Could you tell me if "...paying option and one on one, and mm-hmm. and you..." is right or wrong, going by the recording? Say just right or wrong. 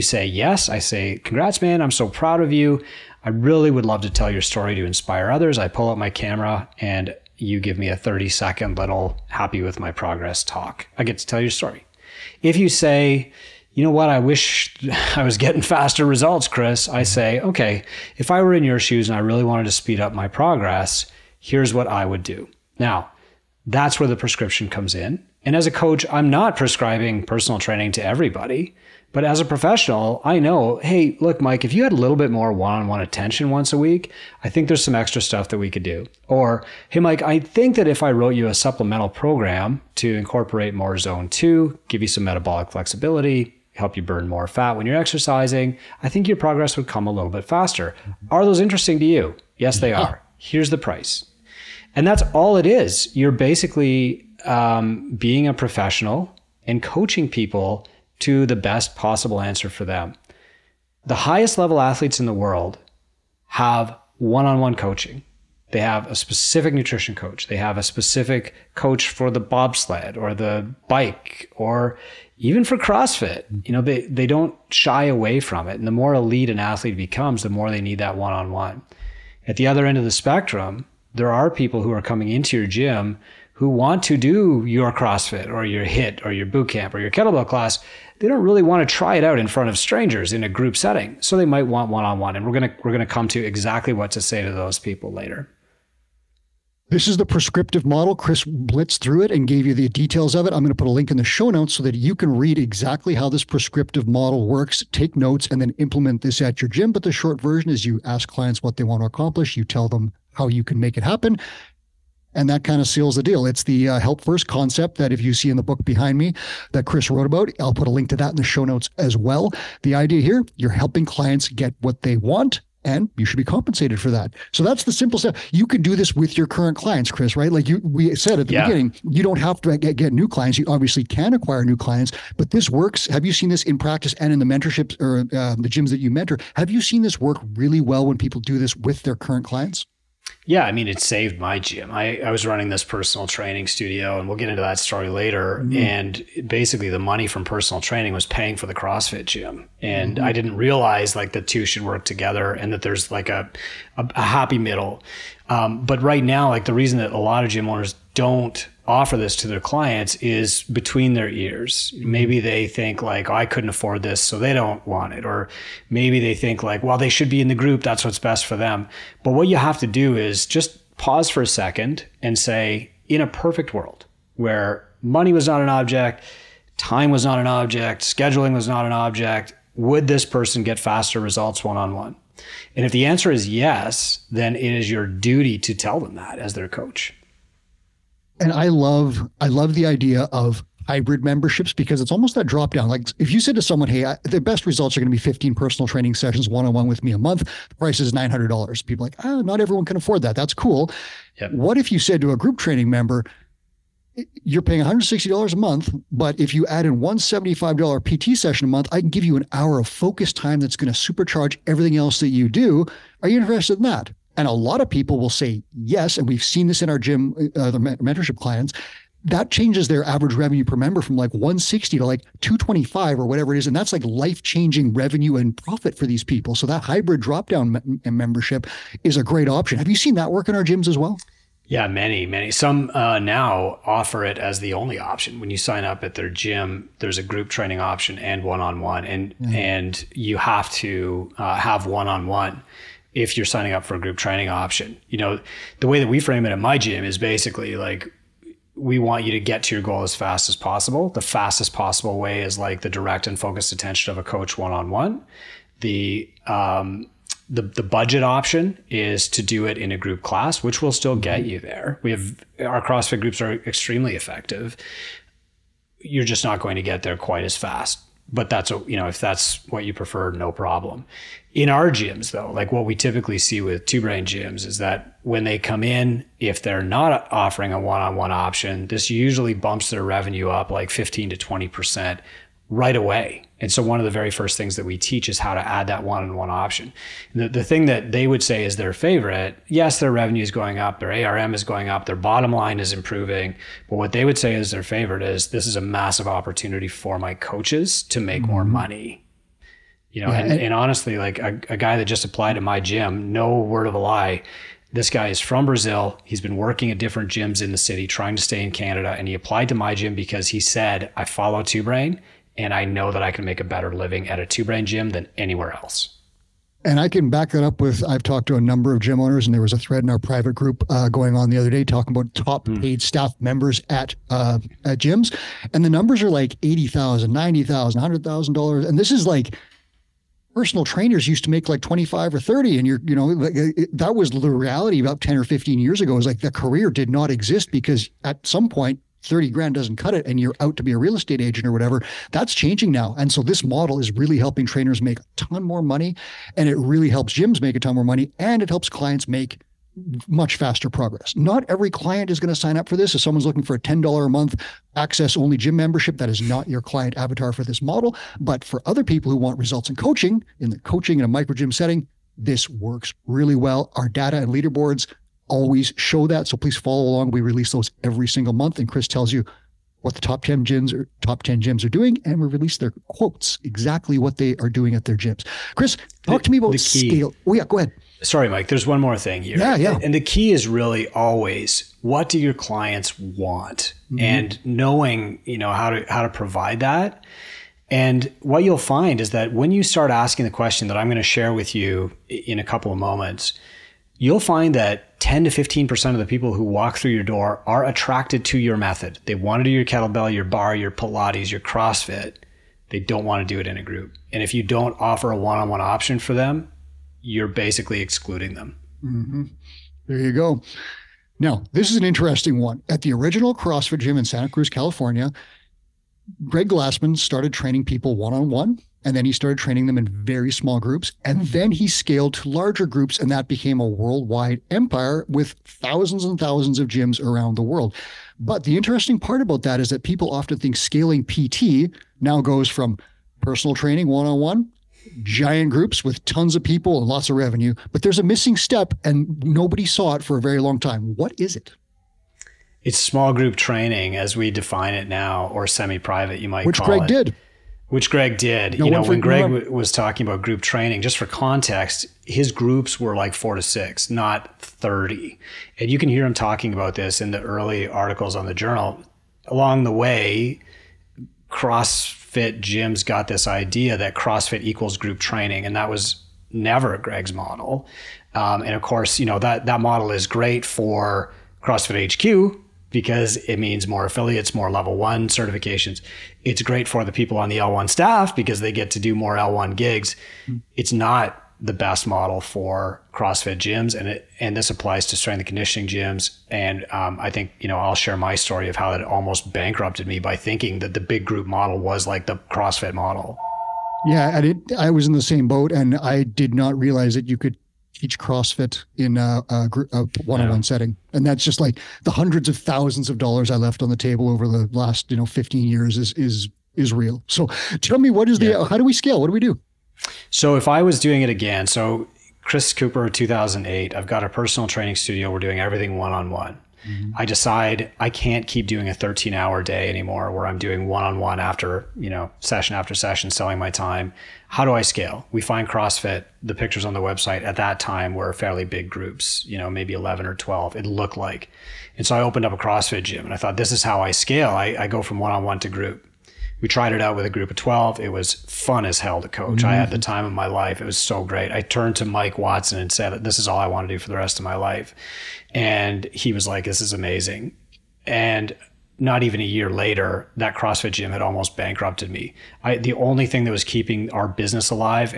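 wrong.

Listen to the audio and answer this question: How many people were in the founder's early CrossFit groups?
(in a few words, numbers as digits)
four to six.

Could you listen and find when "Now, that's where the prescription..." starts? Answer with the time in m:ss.
0:22.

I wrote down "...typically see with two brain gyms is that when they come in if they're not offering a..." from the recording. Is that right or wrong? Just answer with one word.
right.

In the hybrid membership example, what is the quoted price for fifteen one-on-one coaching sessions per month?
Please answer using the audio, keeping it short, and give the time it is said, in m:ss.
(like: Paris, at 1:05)
$900, at 3:18.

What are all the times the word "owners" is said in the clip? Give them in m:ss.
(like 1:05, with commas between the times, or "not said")
2:37, 5:19.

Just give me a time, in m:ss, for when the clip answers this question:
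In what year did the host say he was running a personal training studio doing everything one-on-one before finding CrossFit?
8:33.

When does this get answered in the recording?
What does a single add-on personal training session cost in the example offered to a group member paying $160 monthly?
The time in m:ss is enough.
3:27.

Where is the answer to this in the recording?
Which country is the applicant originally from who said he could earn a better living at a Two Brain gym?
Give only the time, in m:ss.
5:05.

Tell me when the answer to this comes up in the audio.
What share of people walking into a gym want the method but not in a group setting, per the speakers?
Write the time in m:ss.
6:35.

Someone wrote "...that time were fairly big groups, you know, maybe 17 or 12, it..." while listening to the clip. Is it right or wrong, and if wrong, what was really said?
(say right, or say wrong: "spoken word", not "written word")
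wrong: "11", not "17".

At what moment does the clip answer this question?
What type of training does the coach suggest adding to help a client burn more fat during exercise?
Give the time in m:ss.
0:40.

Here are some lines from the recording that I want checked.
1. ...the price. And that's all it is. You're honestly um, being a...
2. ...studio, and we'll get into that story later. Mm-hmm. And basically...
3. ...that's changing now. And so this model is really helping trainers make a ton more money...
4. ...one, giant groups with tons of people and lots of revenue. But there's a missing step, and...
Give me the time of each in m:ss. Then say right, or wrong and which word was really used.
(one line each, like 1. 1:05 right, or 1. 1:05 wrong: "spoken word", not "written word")
1. 0:50 wrong: "basically", not "honestly"
2. 2:23 right
3. 5:42 right
4. 7:14 right.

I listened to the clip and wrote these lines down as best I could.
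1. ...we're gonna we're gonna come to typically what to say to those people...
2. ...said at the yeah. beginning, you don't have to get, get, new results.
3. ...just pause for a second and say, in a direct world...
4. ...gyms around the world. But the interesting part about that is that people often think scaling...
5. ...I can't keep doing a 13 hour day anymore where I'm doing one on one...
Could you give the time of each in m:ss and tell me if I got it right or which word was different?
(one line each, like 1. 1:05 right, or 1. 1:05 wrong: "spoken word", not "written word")
1. 1:32 wrong: "exactly", not "typically"
2. 2:08 wrong: "clients", not "results"
3. 2:50 wrong: "perfect", not "direct"
4. 7:06 right
5. 8:37 right.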